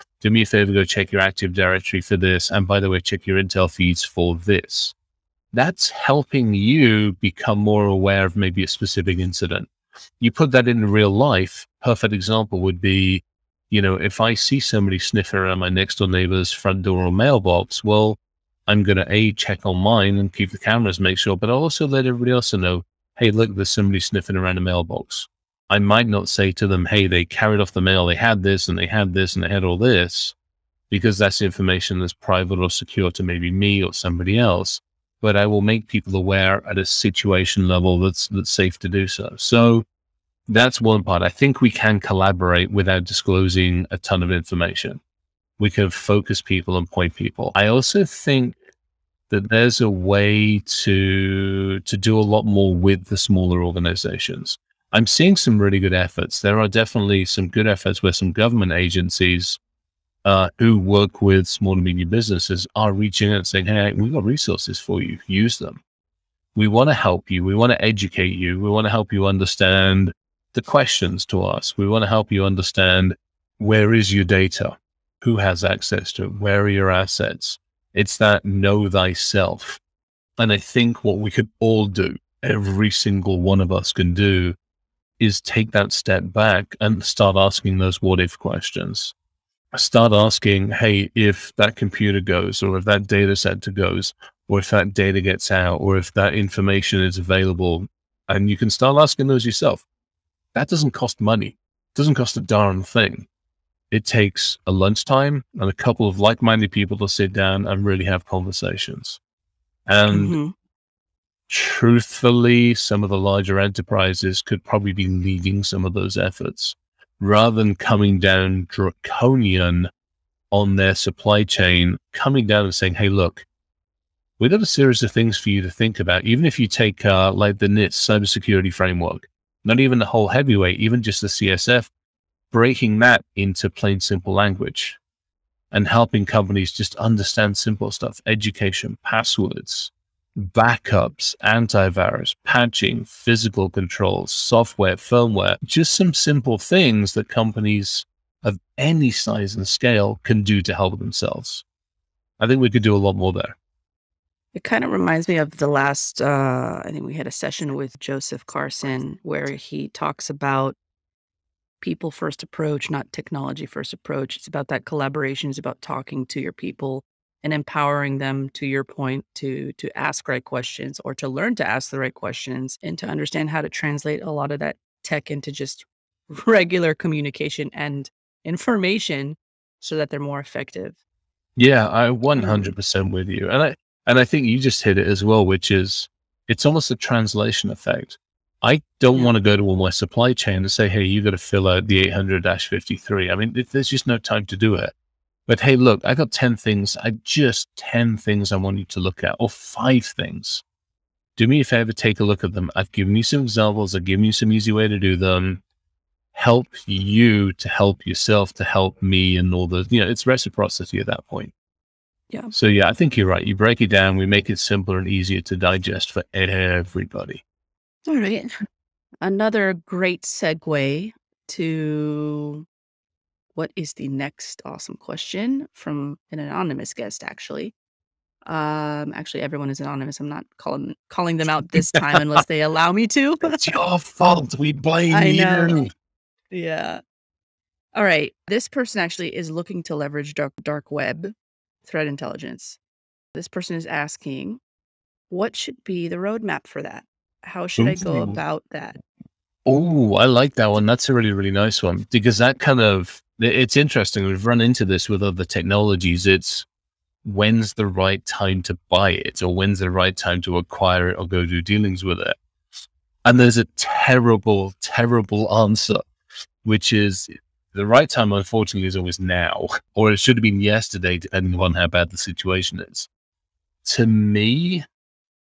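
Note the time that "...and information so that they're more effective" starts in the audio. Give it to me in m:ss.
2:57.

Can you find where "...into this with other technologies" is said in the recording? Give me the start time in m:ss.
4:14.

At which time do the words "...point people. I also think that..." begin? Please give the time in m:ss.
0:46.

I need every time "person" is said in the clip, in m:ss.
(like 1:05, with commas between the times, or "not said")
3:58, 4:03.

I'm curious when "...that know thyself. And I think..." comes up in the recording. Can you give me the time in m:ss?
1:18.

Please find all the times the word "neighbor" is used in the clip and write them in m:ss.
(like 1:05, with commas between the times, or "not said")
0:16.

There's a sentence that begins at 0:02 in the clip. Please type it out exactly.
And by the way, check your Intel feeds for this.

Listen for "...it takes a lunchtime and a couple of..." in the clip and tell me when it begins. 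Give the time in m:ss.
1:43.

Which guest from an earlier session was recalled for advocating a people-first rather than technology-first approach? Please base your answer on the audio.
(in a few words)
Joseph Carson.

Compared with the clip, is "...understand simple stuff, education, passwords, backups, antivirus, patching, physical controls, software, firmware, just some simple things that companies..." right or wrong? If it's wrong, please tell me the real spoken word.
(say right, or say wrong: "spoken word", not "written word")
right.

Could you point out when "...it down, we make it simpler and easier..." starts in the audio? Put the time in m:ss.
3:33.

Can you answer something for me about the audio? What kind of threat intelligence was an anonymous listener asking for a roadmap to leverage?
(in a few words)
Dark web threat intelligence.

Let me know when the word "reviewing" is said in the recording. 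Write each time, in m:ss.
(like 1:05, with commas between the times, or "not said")
not said.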